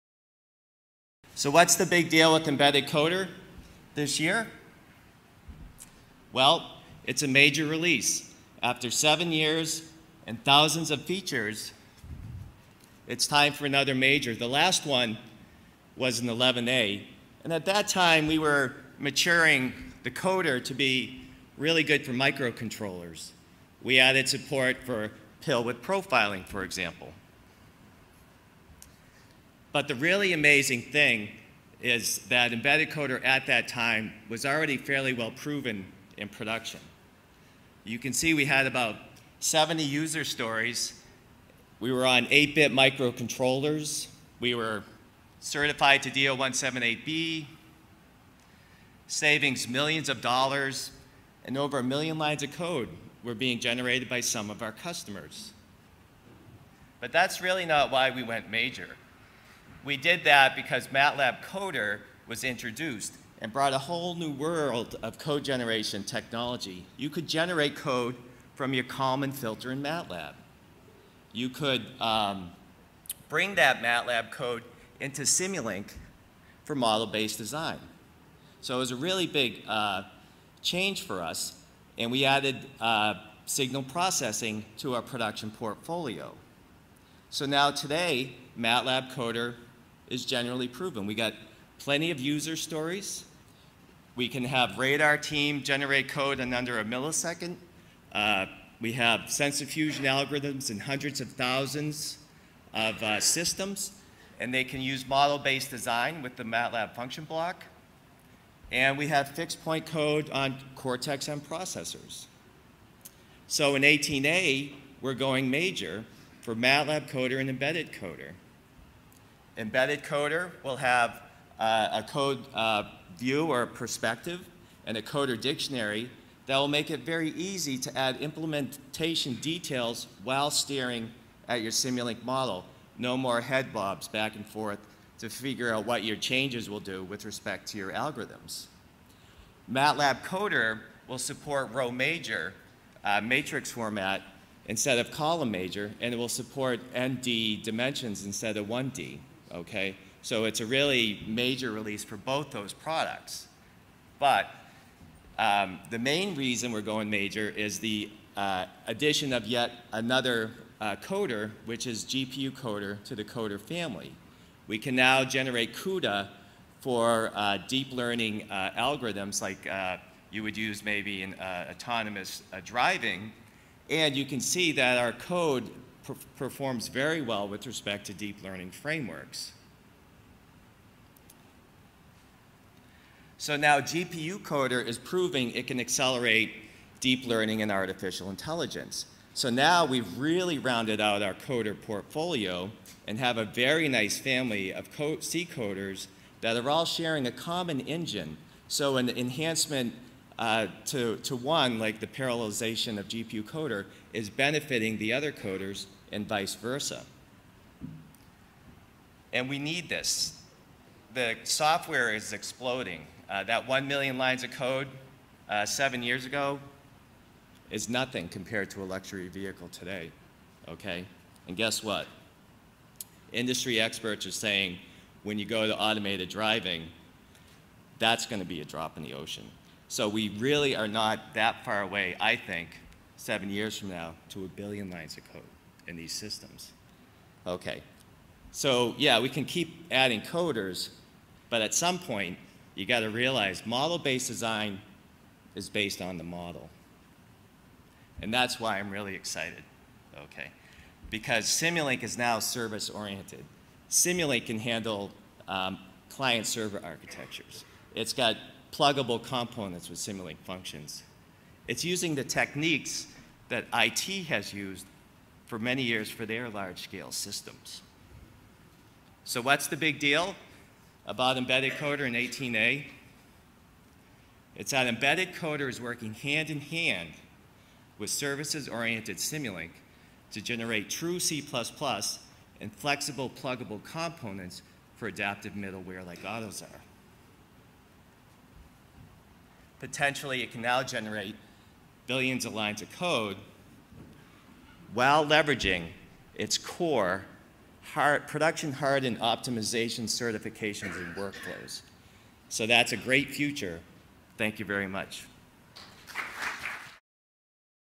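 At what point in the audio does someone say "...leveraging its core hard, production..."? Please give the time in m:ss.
4:55.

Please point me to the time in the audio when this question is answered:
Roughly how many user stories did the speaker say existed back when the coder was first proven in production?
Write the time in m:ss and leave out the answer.
0:39.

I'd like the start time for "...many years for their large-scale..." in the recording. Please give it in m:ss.
4:25.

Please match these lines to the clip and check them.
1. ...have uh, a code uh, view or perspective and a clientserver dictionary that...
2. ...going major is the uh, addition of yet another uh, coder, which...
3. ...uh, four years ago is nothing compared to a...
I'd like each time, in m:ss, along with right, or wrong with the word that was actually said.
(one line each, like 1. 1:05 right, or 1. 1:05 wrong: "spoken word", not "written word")
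1. 2:00 wrong: "coder", not "clientserver"
2. 2:36 right
3. 3:35 wrong: "seven", not "four".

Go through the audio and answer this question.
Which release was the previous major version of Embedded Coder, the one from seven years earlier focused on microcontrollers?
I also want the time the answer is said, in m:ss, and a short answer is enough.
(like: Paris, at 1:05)
11A, at 0:16.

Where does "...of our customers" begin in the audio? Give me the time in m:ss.
0:54.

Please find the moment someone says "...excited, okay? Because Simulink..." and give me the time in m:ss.
4:09.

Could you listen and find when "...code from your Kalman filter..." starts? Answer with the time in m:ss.
1:07.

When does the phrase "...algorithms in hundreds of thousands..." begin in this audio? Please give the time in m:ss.
1:40.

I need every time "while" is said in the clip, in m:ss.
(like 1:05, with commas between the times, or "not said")
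2:10, 4:54.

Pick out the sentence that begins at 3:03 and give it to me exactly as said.
So now GPU Coder is proving it can accelerate deep learning and artificial intelligence.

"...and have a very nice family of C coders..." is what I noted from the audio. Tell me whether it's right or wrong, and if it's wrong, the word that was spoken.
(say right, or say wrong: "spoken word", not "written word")
right.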